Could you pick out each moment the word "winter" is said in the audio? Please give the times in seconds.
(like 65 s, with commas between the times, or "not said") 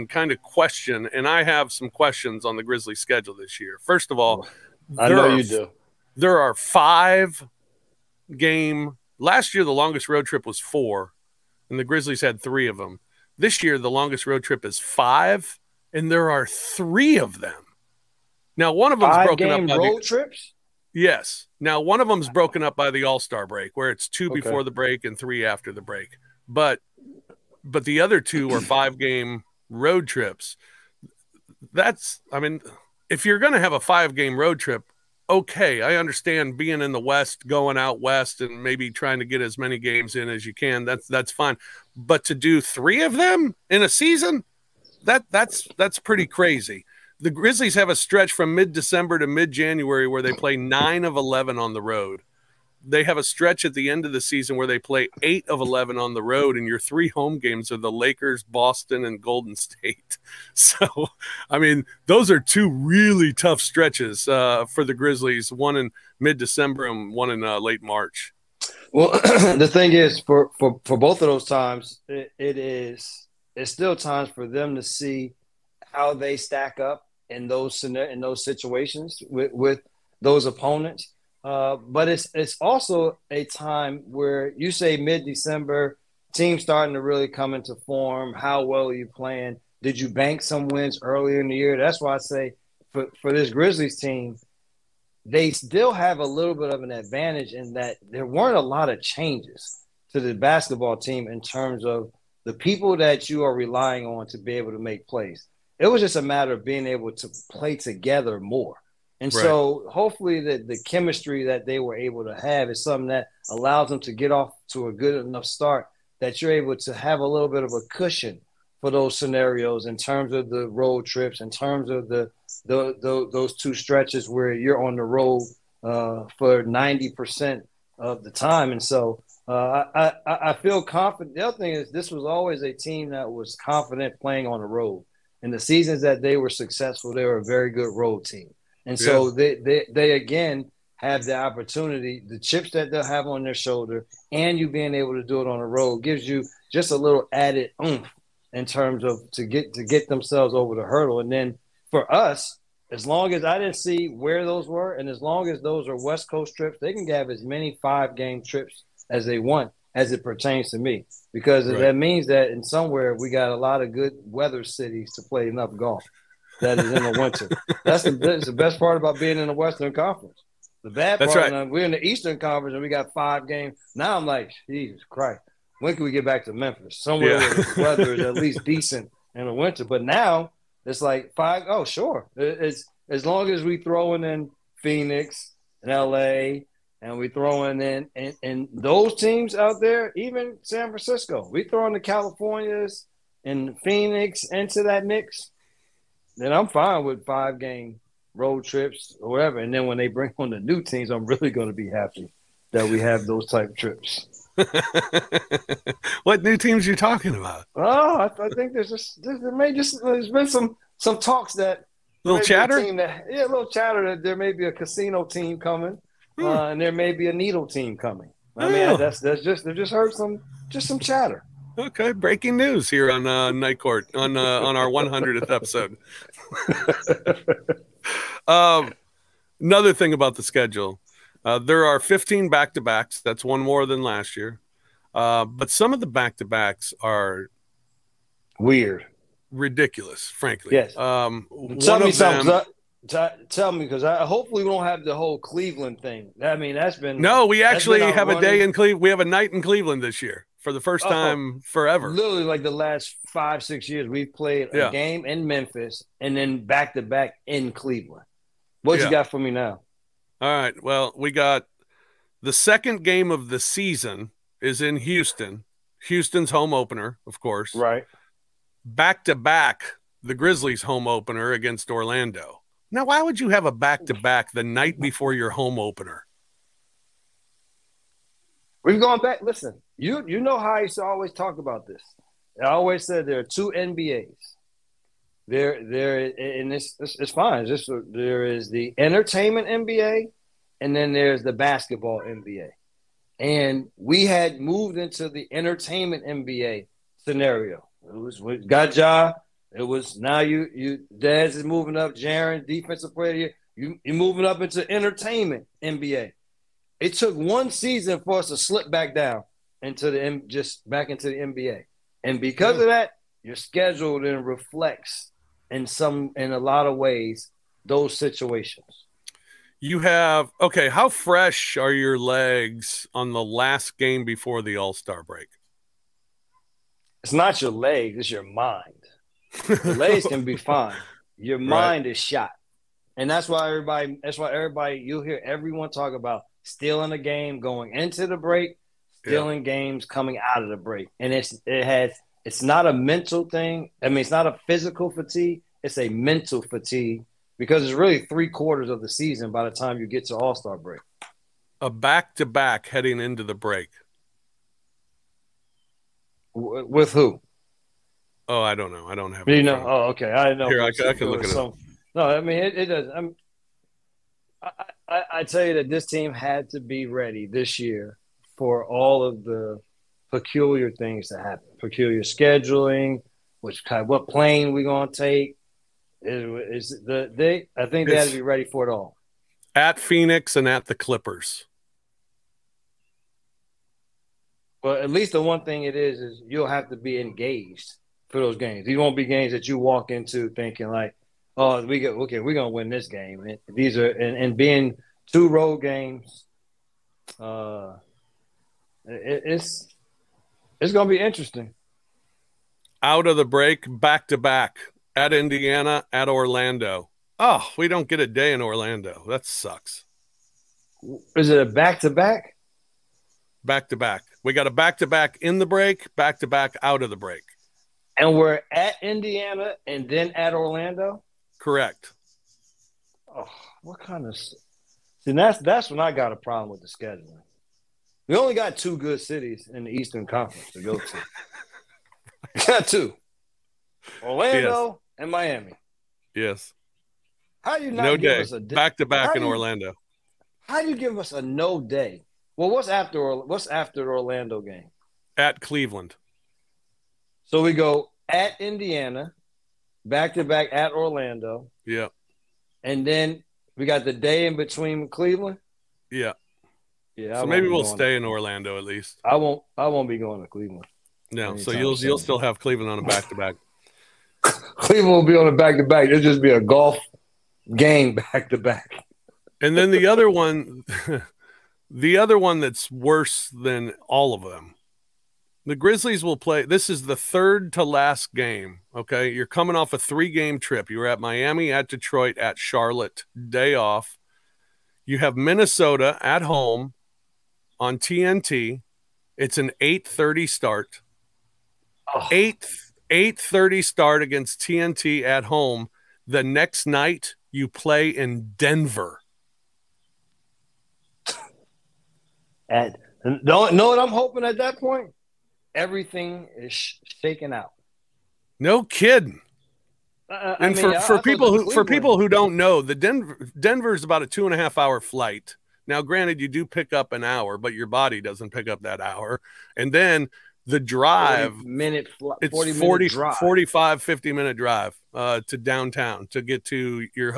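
167 s, 179 s.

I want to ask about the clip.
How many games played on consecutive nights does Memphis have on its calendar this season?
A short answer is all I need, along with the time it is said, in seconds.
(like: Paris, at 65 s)
15, at 232 s.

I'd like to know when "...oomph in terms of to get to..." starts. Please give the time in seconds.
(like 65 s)
147 s.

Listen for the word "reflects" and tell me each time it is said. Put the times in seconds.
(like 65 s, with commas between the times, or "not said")
314 s.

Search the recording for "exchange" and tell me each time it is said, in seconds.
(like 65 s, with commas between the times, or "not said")
not said.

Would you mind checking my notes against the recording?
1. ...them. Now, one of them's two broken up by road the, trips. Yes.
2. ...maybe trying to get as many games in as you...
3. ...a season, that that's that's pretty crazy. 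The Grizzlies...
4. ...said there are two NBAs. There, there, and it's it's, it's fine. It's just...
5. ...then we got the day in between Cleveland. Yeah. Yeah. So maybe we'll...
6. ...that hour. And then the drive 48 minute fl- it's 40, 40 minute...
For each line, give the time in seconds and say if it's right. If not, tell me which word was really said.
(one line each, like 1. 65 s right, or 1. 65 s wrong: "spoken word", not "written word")
1. 17 s wrong: "five", not "two"
2. 38 s right
3. 43 s right
4. 283 s right
5. 453 s right
6. 518 s wrong: "40", not "48".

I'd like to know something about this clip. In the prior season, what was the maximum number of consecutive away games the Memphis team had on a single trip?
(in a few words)
4.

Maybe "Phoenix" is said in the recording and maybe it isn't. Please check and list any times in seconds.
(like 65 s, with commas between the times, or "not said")
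184 s, 193 s, 379 s.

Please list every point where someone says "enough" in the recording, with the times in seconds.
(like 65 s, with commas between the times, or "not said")
115 s, 165 s.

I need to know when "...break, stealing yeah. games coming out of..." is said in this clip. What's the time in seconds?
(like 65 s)
338 s.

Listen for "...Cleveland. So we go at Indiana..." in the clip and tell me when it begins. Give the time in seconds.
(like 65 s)
445 s.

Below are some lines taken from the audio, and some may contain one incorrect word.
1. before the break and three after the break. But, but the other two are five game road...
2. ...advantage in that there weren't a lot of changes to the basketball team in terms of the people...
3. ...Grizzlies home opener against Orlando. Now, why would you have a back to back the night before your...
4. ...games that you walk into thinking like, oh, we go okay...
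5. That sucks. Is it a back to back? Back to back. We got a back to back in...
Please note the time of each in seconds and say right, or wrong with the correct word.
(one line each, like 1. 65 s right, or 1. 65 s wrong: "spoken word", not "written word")
1. 24 s right
2. 96 s right
3. 270 s right
4. 389 s right
5. 409 s right.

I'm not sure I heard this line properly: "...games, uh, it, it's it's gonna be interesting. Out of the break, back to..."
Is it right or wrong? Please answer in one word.
right.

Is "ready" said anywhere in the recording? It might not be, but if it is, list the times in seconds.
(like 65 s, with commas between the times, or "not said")
367 s, 378 s.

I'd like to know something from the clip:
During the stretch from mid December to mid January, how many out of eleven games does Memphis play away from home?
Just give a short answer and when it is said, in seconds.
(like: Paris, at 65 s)
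9, at 50 s.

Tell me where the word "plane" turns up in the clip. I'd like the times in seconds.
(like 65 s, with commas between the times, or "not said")
374 s.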